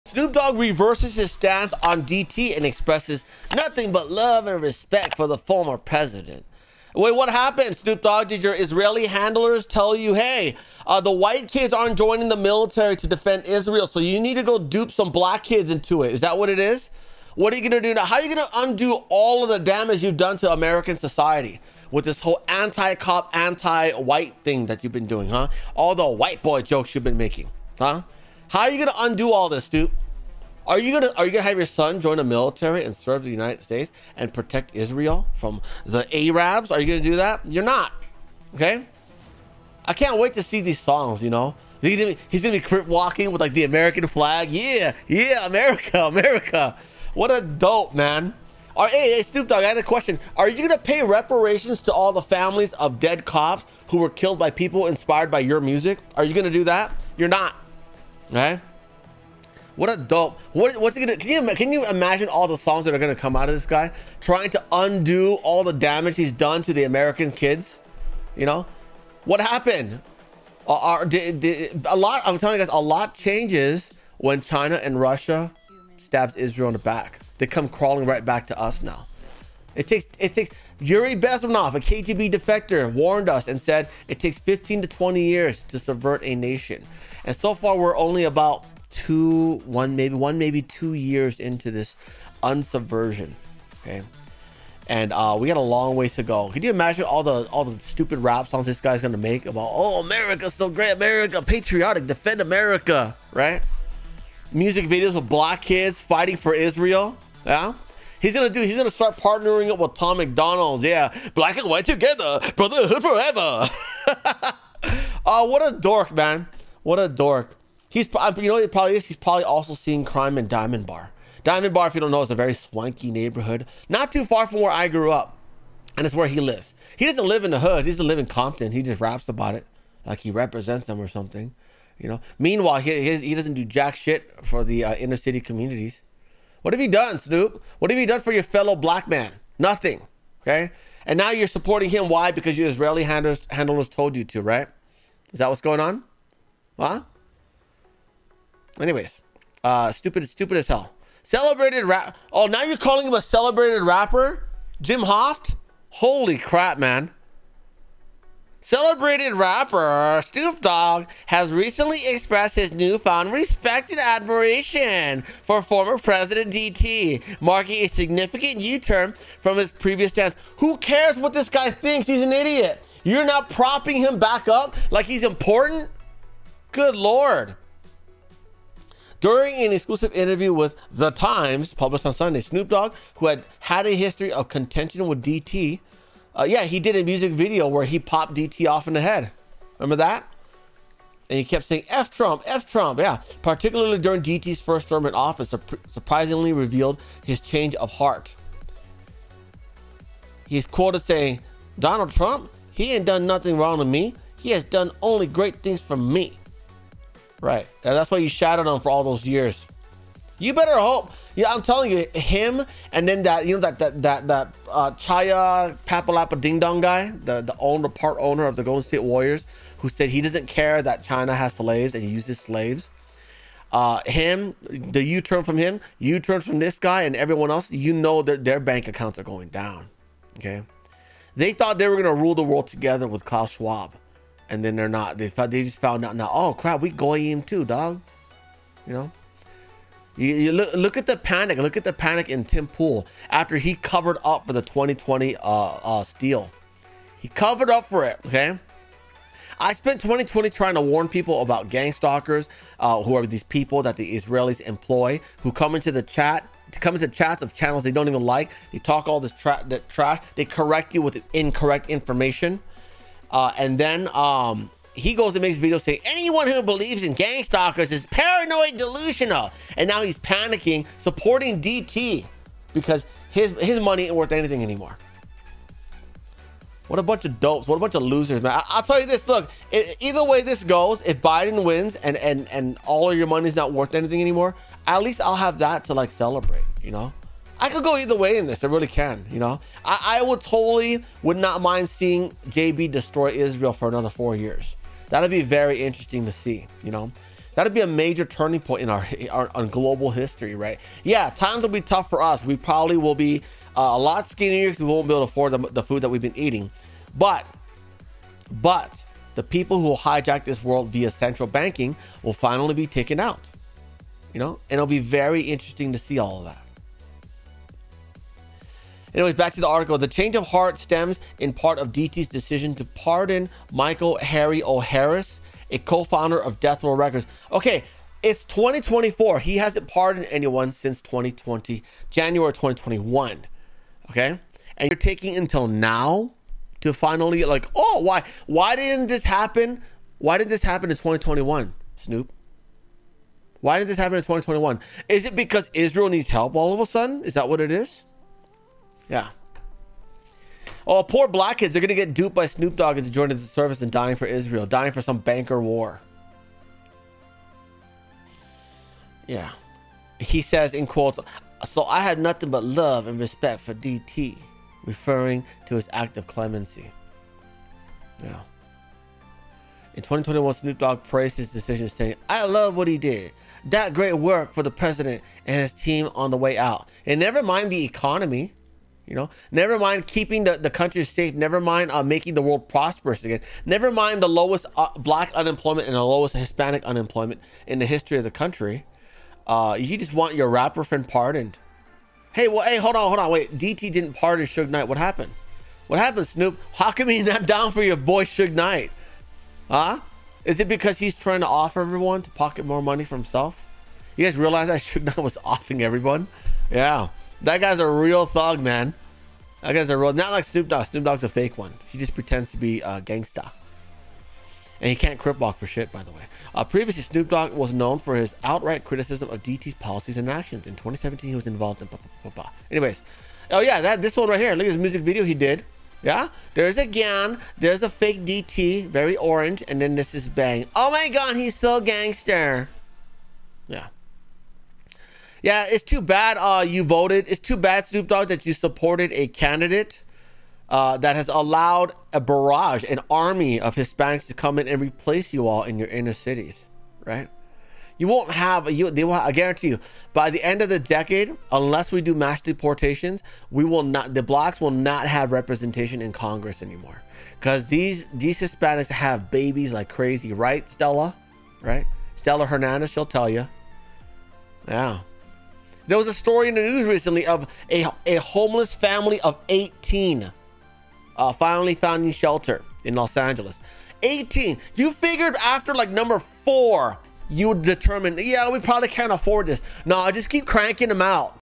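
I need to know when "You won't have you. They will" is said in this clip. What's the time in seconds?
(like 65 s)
447 s.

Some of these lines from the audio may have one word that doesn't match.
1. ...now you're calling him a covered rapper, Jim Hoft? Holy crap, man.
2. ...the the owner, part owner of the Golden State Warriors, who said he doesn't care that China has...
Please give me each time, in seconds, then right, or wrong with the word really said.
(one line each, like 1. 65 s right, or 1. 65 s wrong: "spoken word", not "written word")
1. 152 s wrong: "celebrated", not "covered"
2. 217 s right.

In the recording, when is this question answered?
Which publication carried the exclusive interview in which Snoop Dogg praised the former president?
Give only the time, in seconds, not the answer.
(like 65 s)
180 s.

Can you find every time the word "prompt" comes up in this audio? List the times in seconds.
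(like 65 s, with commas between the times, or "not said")
not said.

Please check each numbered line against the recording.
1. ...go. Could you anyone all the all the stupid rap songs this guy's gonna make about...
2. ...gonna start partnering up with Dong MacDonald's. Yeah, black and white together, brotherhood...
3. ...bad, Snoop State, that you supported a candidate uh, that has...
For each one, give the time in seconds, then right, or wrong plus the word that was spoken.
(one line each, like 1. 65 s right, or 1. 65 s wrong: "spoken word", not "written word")
1. 96 s wrong: "imagine", not "anyone"
2. 108 s wrong: "Tom", not "Dong"
3. 437 s wrong: "Dogg", not "State".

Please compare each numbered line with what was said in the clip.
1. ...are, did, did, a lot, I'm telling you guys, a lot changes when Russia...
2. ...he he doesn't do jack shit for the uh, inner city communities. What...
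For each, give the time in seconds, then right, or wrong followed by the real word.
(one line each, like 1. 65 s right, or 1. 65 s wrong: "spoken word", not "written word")
1. 70 s wrong: "China", not "Russia"
2. 132 s right.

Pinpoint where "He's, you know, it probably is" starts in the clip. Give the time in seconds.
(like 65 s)
117 s.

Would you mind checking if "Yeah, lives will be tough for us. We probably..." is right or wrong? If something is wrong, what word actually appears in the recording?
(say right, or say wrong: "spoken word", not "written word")
wrong: "times", not "lives".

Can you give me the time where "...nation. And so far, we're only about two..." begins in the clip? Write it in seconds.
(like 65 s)
86 s.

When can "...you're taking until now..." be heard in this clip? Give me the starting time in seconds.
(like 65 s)
334 s.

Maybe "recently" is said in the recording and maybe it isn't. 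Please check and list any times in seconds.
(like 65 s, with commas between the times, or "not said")
161 s, 466 s.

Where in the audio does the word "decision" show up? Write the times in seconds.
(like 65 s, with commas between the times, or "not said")
322 s, 371 s.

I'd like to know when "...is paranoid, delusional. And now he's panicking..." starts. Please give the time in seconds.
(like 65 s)
267 s.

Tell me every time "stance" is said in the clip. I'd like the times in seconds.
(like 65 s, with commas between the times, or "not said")
1 s, 170 s.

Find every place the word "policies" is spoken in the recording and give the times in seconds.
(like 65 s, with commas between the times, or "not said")
419 s.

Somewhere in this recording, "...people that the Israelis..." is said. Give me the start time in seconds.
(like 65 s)
253 s.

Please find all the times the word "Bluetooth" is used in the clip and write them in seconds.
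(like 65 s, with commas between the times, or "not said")
not said.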